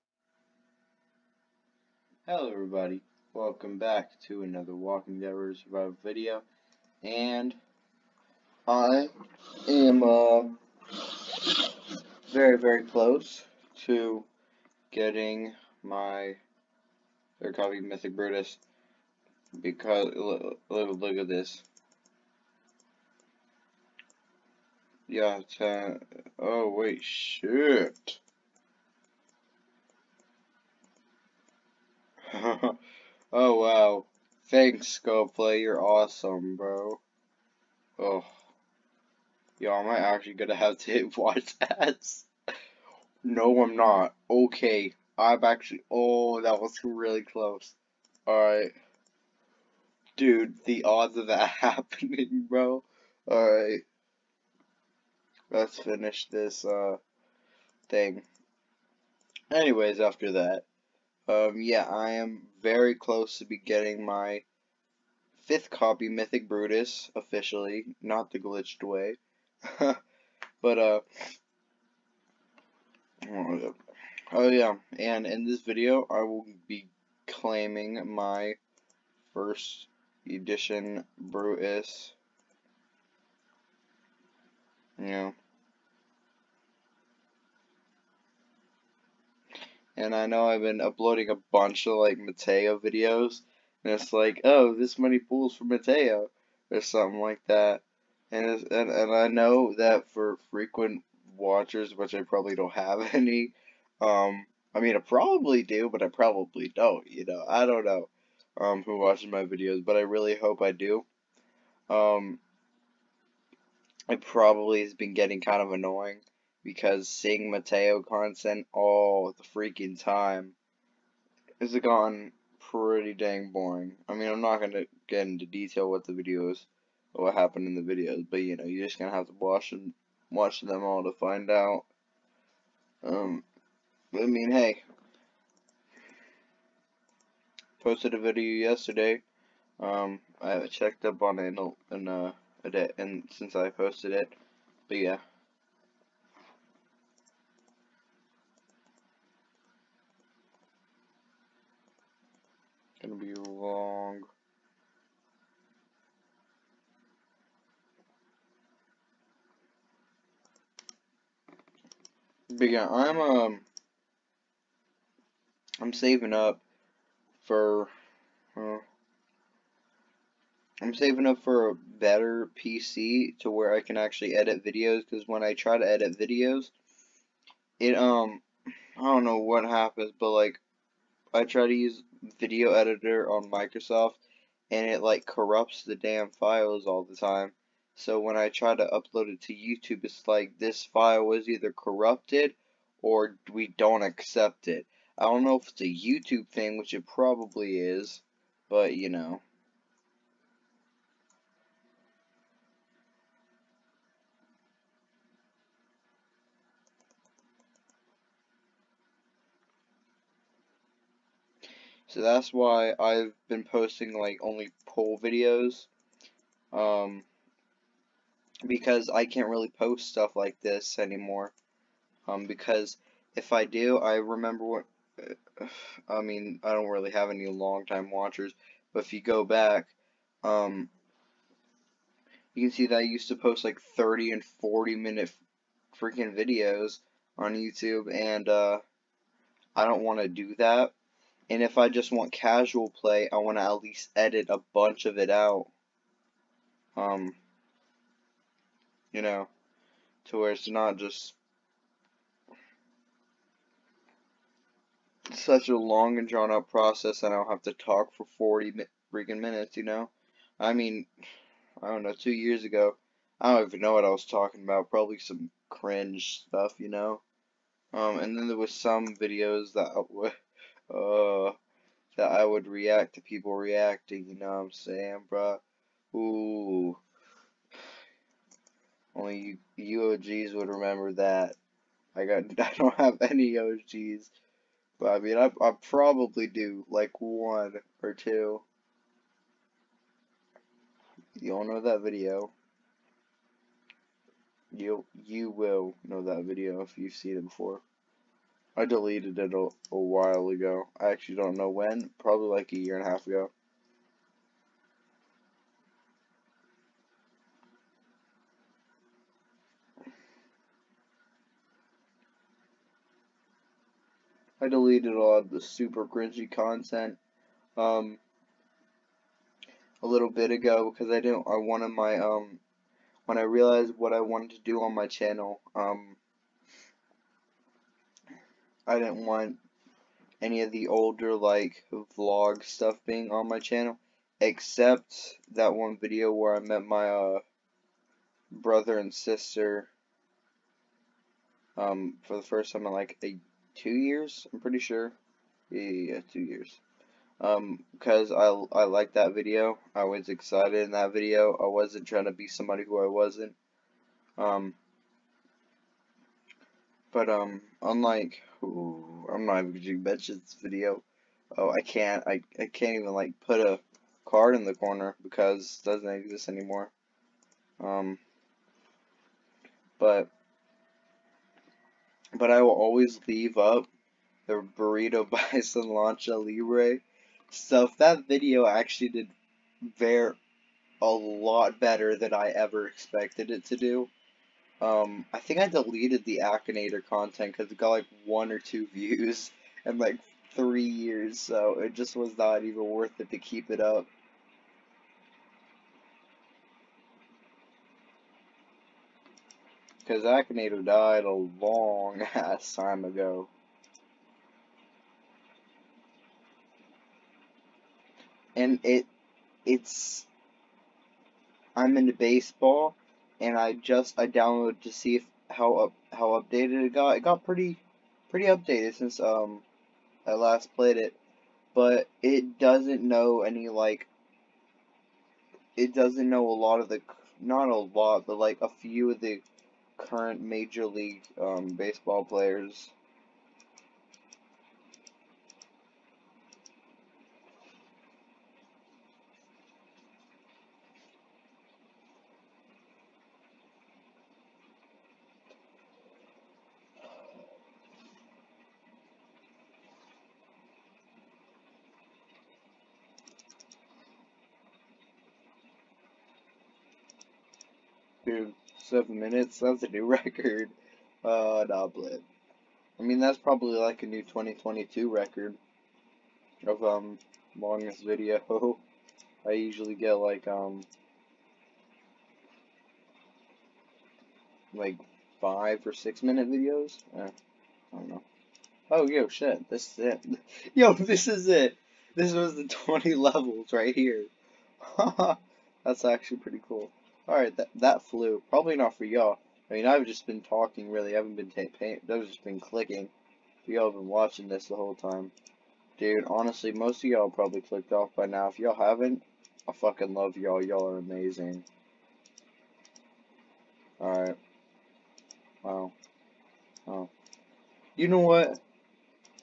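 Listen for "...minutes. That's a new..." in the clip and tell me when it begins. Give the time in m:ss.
7:39.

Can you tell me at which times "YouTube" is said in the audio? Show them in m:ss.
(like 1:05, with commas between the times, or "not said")
3:09, 3:15, 3:57.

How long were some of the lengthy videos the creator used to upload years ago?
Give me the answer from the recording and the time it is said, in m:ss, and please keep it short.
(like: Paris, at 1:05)
30 and 40 minutes, at 3:53.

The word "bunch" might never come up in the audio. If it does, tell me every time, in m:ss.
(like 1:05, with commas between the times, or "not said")
1:31, 4:04.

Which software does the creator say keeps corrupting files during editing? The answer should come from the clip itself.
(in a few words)
video editor on Microsoft.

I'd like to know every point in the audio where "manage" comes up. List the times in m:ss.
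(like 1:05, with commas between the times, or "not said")
not said.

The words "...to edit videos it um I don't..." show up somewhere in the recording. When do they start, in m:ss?
2:55.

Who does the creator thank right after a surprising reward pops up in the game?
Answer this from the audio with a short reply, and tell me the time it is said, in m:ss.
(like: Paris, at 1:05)
GoPlay, at 0:35.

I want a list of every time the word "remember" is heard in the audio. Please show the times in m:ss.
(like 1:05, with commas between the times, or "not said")
3:44, 4:40.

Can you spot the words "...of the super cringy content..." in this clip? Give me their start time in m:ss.
5:15.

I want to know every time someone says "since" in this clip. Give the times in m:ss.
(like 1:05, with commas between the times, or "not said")
2:23, 6:58.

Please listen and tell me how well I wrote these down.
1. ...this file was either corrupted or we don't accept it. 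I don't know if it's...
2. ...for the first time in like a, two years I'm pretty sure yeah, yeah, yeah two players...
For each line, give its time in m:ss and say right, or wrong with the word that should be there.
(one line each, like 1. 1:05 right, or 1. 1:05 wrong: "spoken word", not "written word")
1. 3:10 right
2. 5:42 wrong: "years", not "players".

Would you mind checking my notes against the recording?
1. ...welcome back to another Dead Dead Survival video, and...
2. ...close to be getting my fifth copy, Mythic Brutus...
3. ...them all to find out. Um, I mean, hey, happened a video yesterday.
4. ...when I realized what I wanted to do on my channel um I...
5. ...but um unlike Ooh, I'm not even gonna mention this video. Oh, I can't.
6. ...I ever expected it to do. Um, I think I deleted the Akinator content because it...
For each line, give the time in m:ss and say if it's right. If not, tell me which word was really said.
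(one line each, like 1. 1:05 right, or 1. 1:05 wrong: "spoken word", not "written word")
1. 0:03 wrong: "Walking", not "Dead"
2. 1:02 right
3. 2:10 wrong: "posted", not "happened"
4. 5:23 right
5. 5:57 right
6. 6:22 right.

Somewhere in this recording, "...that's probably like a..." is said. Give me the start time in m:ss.
7:43.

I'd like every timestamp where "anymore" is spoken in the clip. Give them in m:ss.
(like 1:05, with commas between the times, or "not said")
3:40, 6:06.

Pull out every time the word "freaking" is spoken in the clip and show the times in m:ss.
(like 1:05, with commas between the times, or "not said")
1:59, 3:56, 4:19.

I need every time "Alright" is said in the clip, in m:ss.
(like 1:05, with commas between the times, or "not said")
0:48, 0:53, 8:07, 8:24.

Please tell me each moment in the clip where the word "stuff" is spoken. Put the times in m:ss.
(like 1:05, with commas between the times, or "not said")
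3:40, 4:26, 5:32.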